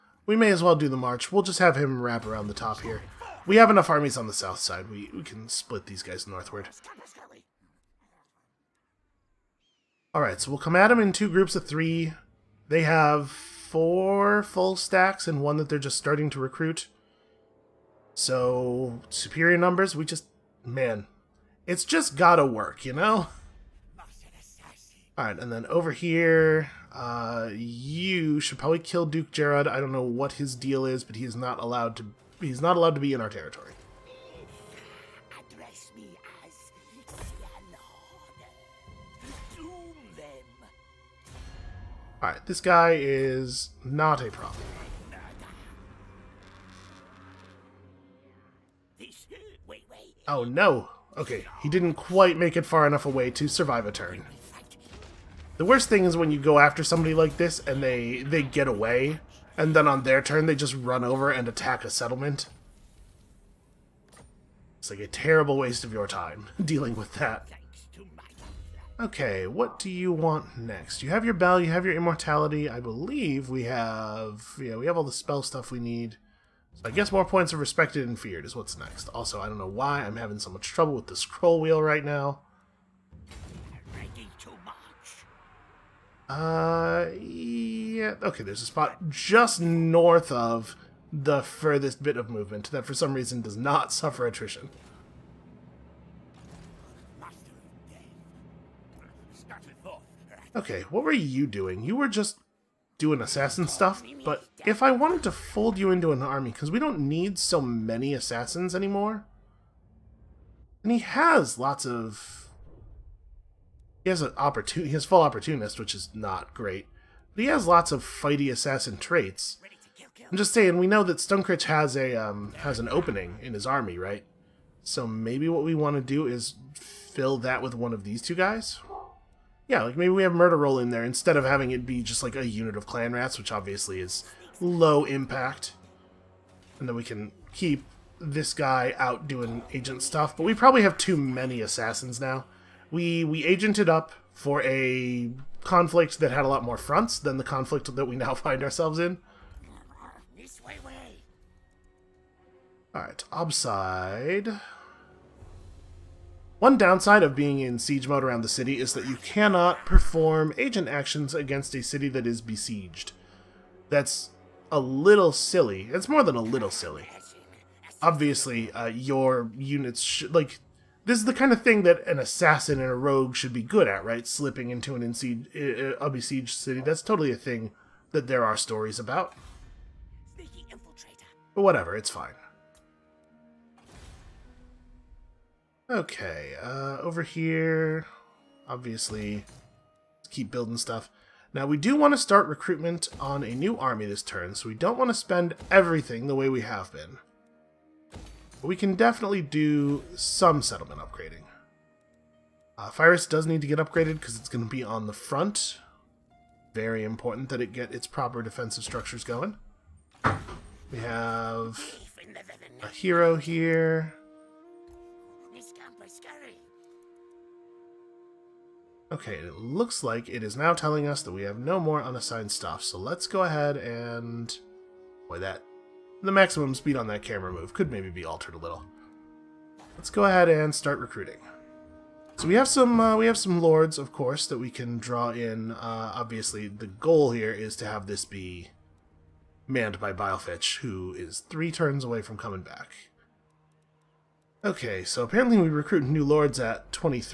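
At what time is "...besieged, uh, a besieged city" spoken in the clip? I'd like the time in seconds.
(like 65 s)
175 s.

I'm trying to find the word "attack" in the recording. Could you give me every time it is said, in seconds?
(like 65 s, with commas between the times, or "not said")
61 s.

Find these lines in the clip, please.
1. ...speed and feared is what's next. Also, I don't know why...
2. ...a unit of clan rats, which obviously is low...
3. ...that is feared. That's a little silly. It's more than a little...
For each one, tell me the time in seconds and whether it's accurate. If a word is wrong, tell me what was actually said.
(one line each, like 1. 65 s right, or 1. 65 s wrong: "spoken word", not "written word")
1. 77 s wrong: "respected", not "speed"
2. 132 s right
3. 162 s wrong: "besieged", not "feared".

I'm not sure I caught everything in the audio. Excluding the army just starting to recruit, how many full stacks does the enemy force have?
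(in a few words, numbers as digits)
4.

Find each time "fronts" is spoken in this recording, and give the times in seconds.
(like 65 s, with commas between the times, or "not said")
146 s, 205 s.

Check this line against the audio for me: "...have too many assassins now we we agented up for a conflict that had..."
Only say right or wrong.
right.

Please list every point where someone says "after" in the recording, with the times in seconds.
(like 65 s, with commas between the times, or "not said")
56 s.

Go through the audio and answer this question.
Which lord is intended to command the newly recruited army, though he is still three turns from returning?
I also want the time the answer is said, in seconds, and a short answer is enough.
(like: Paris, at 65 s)
Bilefetch, at 240 s.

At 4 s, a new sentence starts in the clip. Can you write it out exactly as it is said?
We, we can split these guys northward.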